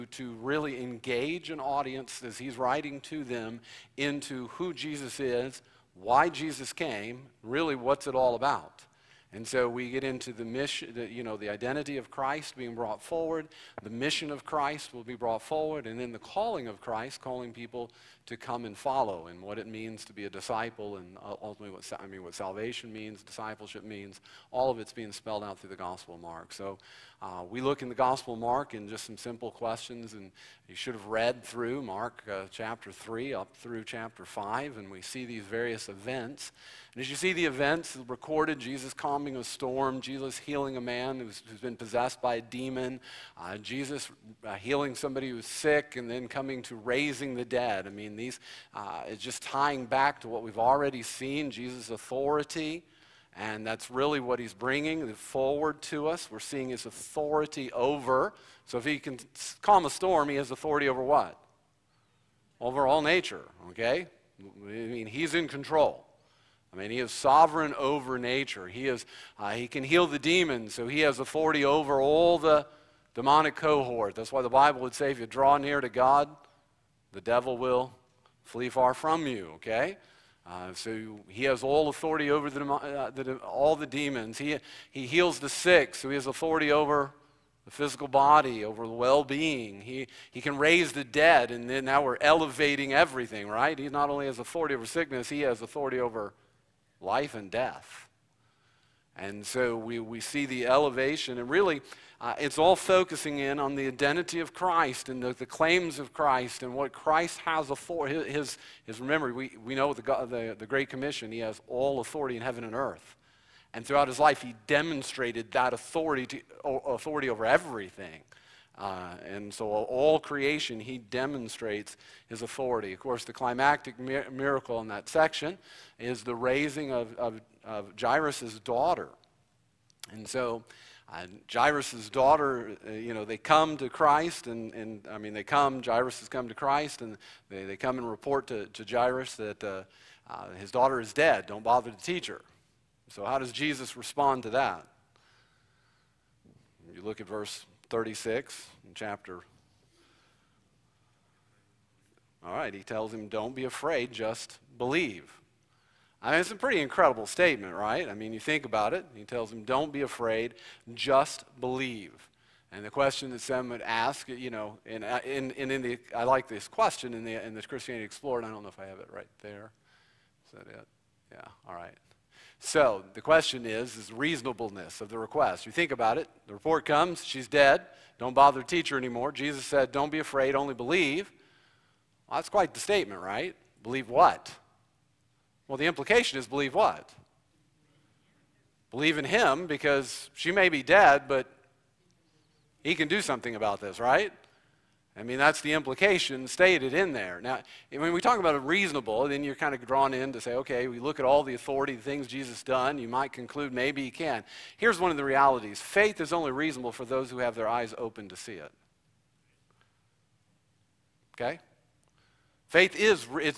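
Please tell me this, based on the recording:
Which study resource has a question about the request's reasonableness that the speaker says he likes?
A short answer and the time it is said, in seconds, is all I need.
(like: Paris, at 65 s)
Christianity Explored, at 167 s.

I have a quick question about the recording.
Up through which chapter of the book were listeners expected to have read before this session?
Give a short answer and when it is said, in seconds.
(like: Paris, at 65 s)
chapter 5, at 33 s.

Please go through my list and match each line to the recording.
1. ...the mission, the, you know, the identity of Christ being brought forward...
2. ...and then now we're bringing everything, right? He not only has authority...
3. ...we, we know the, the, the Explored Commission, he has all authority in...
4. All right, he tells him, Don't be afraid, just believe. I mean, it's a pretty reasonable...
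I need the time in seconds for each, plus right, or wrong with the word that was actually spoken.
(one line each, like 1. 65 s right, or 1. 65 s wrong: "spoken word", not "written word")
1. 10 s right
2. 91 s wrong: "elevating", not "bringing"
3. 109 s wrong: "Great", not "Explored"
4. 152 s wrong: "incredible", not "reasonable".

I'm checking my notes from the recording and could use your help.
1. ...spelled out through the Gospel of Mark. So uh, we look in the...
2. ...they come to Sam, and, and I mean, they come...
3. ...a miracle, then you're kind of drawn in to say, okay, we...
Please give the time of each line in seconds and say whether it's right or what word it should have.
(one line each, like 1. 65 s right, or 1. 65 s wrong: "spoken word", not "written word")
1. 25 s right
2. 133 s wrong: "Christ", not "Sam"
3. 198 s wrong: "reasonable", not "miracle".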